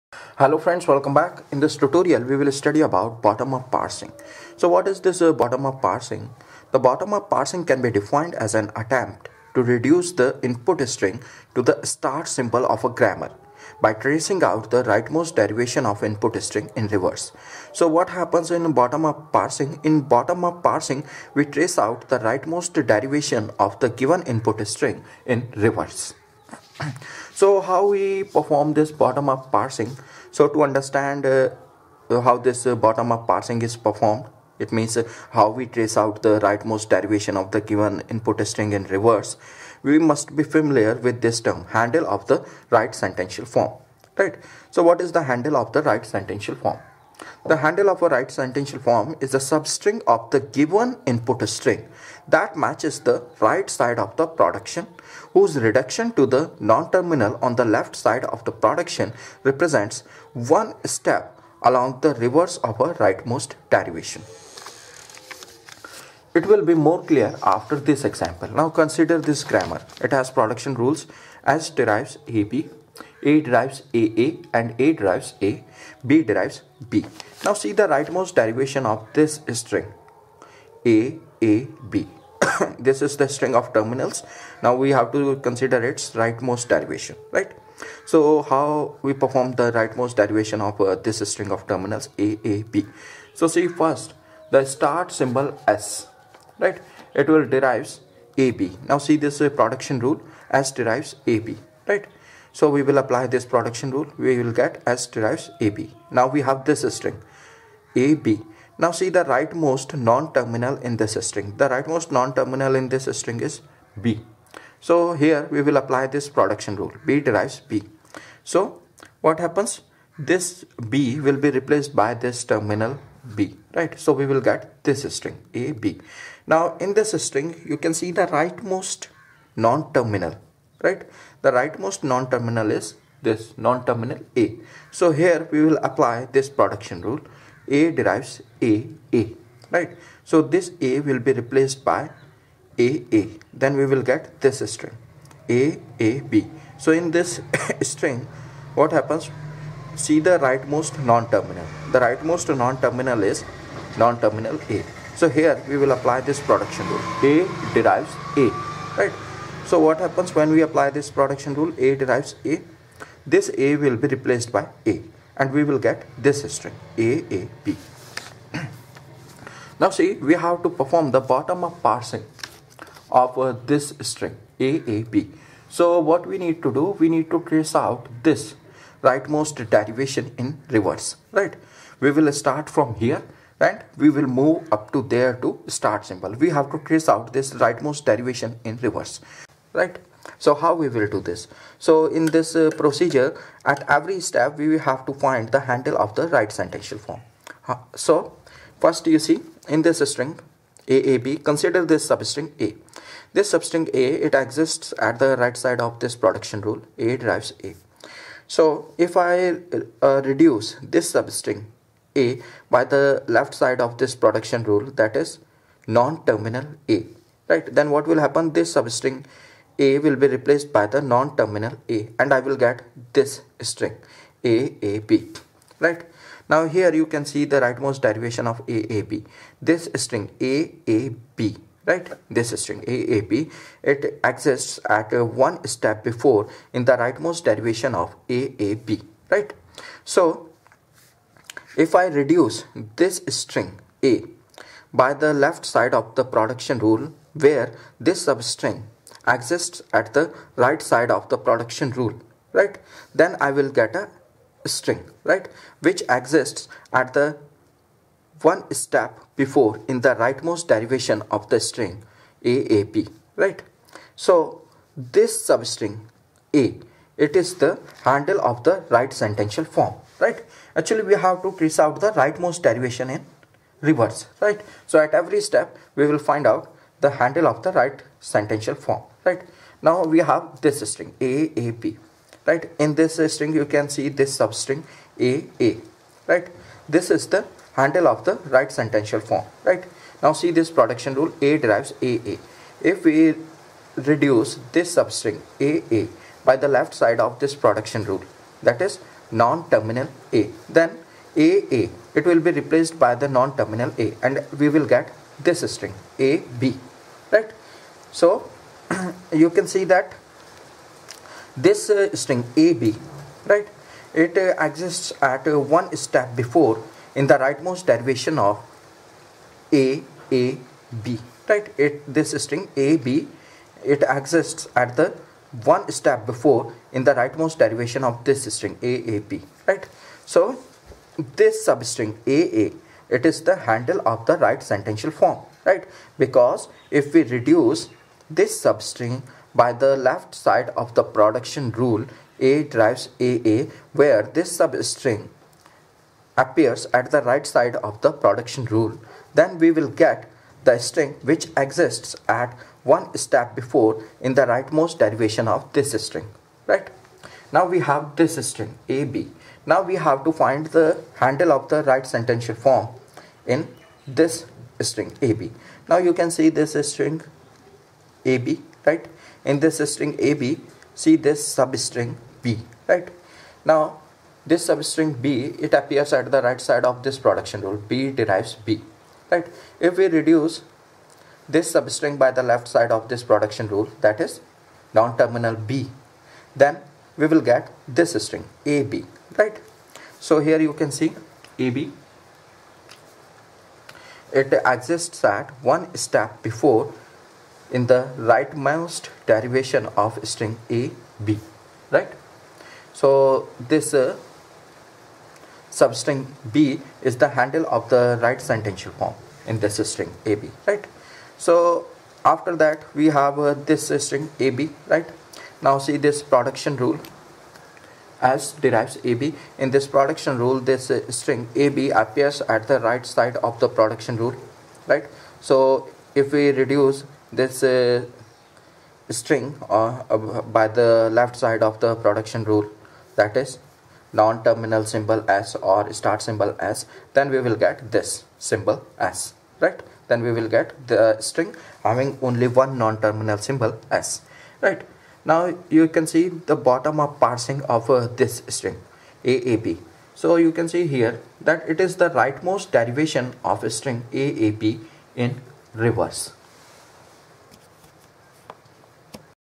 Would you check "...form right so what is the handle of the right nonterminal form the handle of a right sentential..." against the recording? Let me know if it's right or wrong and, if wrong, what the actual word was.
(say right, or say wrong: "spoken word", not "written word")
wrong: "sentential", not "nonterminal".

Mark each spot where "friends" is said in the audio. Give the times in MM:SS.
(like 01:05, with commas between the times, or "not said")
00:00.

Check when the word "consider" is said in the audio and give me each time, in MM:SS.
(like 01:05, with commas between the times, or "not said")
01:08, 01:25, 03:21.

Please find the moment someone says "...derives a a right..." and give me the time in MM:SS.
02:17.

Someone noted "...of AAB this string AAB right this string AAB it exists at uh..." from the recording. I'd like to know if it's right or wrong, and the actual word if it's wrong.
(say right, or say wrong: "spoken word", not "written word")
right.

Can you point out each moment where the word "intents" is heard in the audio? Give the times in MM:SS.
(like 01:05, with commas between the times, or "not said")
not said.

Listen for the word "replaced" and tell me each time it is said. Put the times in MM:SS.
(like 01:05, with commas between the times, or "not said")
02:01, 02:21, 02:44, 03:40, 05:02.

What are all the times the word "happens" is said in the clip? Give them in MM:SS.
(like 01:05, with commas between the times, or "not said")
00:18, 01:59, 02:28, 02:40, 03:38.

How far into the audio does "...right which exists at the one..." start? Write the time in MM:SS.
04:15.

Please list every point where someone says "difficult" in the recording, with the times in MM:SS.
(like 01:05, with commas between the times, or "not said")
not said.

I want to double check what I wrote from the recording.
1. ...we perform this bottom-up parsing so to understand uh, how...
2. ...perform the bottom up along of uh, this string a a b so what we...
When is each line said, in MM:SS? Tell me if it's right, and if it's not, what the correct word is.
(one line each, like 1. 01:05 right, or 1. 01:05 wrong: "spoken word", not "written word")
1. 00:27 right
2. 02:50 wrong: "parsing", not "along".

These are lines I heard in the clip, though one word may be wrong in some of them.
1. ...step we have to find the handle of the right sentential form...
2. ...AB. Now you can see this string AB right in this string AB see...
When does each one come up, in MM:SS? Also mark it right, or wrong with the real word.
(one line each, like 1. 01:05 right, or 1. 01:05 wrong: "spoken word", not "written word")
1. 03:14 right
2. 06:05 right.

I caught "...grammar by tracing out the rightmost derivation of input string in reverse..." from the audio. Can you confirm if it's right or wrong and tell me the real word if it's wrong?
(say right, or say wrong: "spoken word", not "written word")
right.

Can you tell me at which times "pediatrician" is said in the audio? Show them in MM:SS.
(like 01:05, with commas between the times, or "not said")
not said.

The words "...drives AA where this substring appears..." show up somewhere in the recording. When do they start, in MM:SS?
05:42.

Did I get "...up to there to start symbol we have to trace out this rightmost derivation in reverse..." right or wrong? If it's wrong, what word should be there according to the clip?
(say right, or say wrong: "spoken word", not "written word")
right.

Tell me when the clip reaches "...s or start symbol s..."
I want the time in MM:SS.
07:15.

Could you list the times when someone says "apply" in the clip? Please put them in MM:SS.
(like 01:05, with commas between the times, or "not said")
01:42, 01:55, 02:15, 02:35, 02:40.